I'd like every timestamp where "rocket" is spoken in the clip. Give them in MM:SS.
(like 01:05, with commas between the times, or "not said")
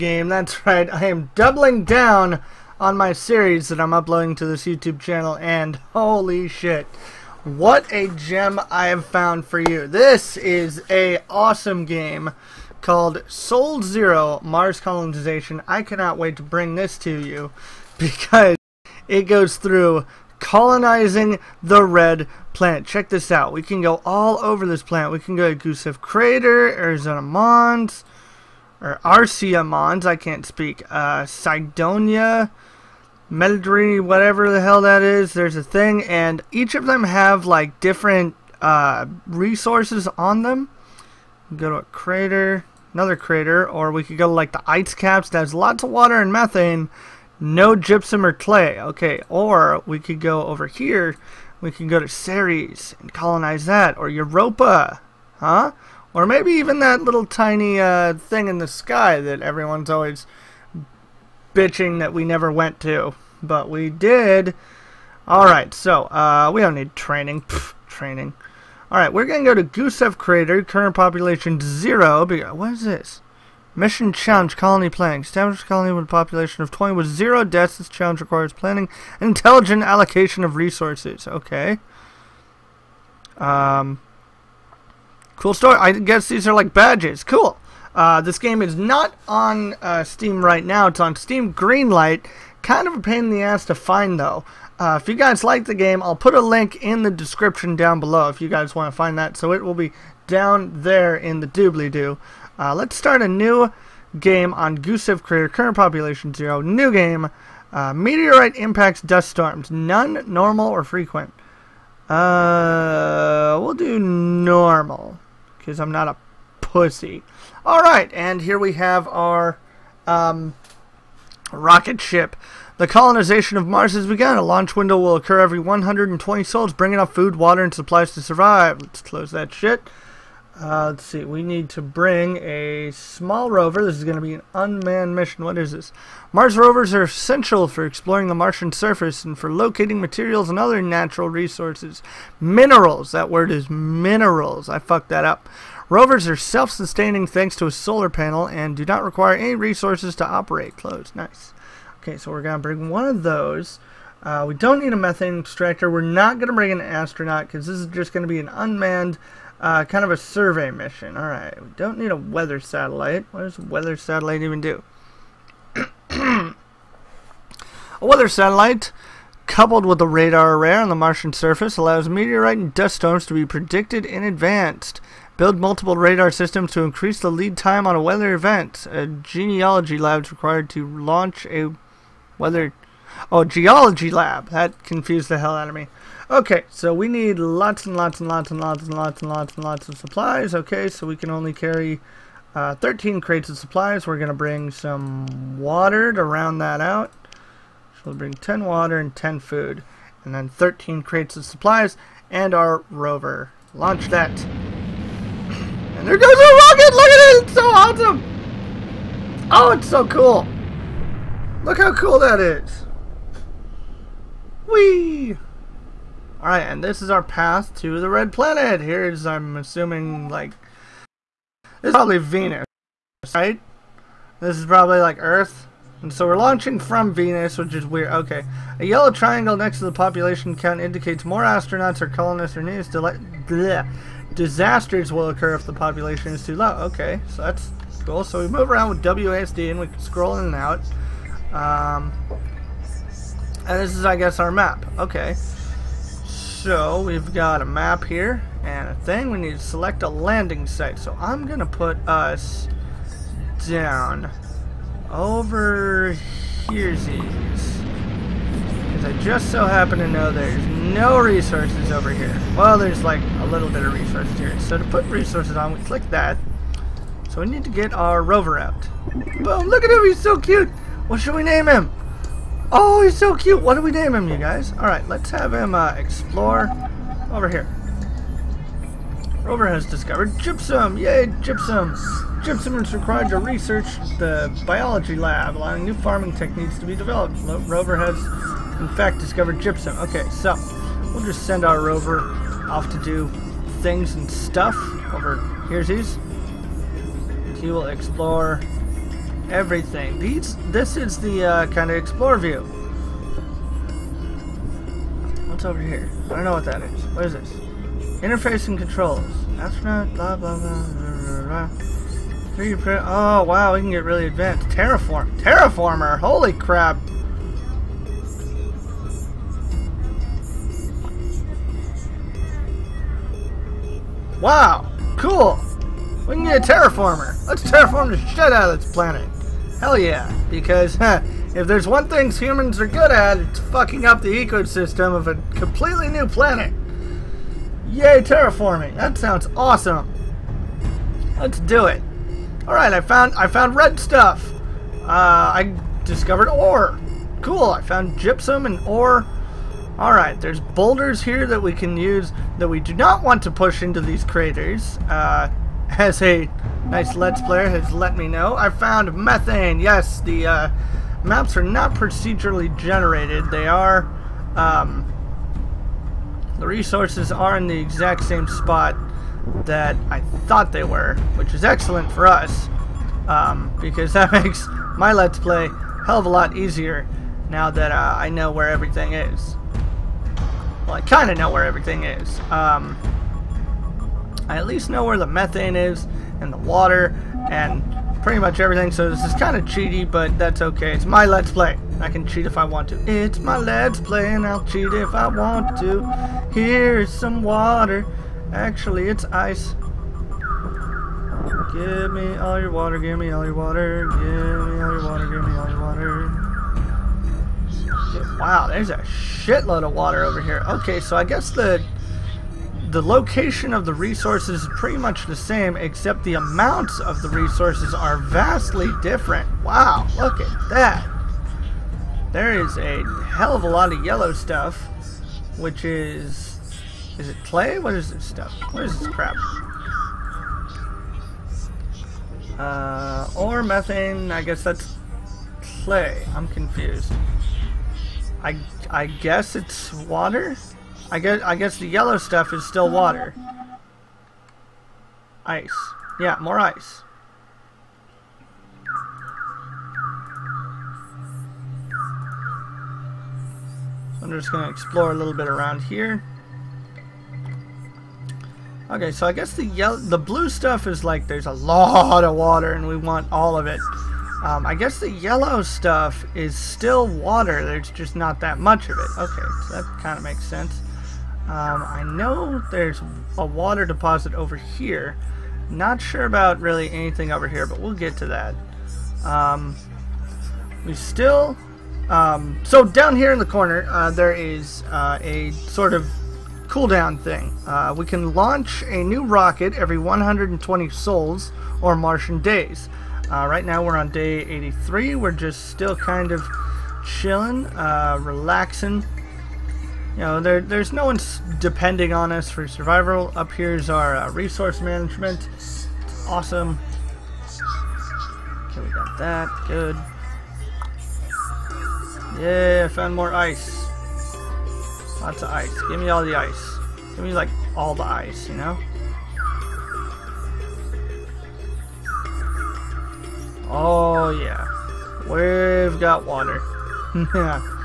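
02:01, 03:26, 08:09.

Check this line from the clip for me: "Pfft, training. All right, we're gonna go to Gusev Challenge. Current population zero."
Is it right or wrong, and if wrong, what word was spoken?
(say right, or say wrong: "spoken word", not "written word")
wrong: "Crater", not "Challenge".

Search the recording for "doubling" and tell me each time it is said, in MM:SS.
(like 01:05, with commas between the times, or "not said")
00:01.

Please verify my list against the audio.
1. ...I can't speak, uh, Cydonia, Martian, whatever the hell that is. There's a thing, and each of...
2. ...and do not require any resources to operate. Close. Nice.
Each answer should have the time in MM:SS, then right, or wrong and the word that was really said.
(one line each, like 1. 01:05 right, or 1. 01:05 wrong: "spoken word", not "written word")
1. 00:30 wrong: "Meldry", not "Martian"
2. 02:28 right.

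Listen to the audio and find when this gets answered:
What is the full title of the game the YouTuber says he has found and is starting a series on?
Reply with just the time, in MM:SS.
00:13.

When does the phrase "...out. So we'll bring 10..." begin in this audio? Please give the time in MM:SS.
03:16.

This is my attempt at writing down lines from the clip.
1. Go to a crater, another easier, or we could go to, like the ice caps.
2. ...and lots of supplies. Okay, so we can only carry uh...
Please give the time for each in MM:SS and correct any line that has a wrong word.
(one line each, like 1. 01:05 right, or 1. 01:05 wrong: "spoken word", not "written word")
1. 00:41 wrong: "crater", not "easier"
2. 03:09 right.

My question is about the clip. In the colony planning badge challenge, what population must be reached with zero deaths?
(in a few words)
20.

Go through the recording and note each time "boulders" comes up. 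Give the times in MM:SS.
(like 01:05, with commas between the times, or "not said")
05:50.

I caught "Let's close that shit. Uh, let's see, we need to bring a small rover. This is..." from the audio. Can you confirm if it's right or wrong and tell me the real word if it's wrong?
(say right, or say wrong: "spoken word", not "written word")
right.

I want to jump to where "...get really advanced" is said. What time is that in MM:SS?
05:13.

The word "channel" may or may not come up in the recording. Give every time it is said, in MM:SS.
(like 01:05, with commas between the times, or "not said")
00:04.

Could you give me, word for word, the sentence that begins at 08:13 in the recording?
Uh, right now we're on day 83.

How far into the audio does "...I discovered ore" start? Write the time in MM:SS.
05:45.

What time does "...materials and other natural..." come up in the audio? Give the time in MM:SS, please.
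02:19.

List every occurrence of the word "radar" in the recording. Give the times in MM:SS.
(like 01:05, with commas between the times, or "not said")
02:50, 02:55.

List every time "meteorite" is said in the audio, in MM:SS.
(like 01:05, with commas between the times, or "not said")
01:47, 02:52.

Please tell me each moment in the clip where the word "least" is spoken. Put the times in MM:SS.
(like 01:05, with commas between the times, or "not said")
06:24.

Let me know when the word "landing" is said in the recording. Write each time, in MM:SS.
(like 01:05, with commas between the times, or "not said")
04:10.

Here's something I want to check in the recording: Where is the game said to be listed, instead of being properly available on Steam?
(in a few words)
Steam Greenlight.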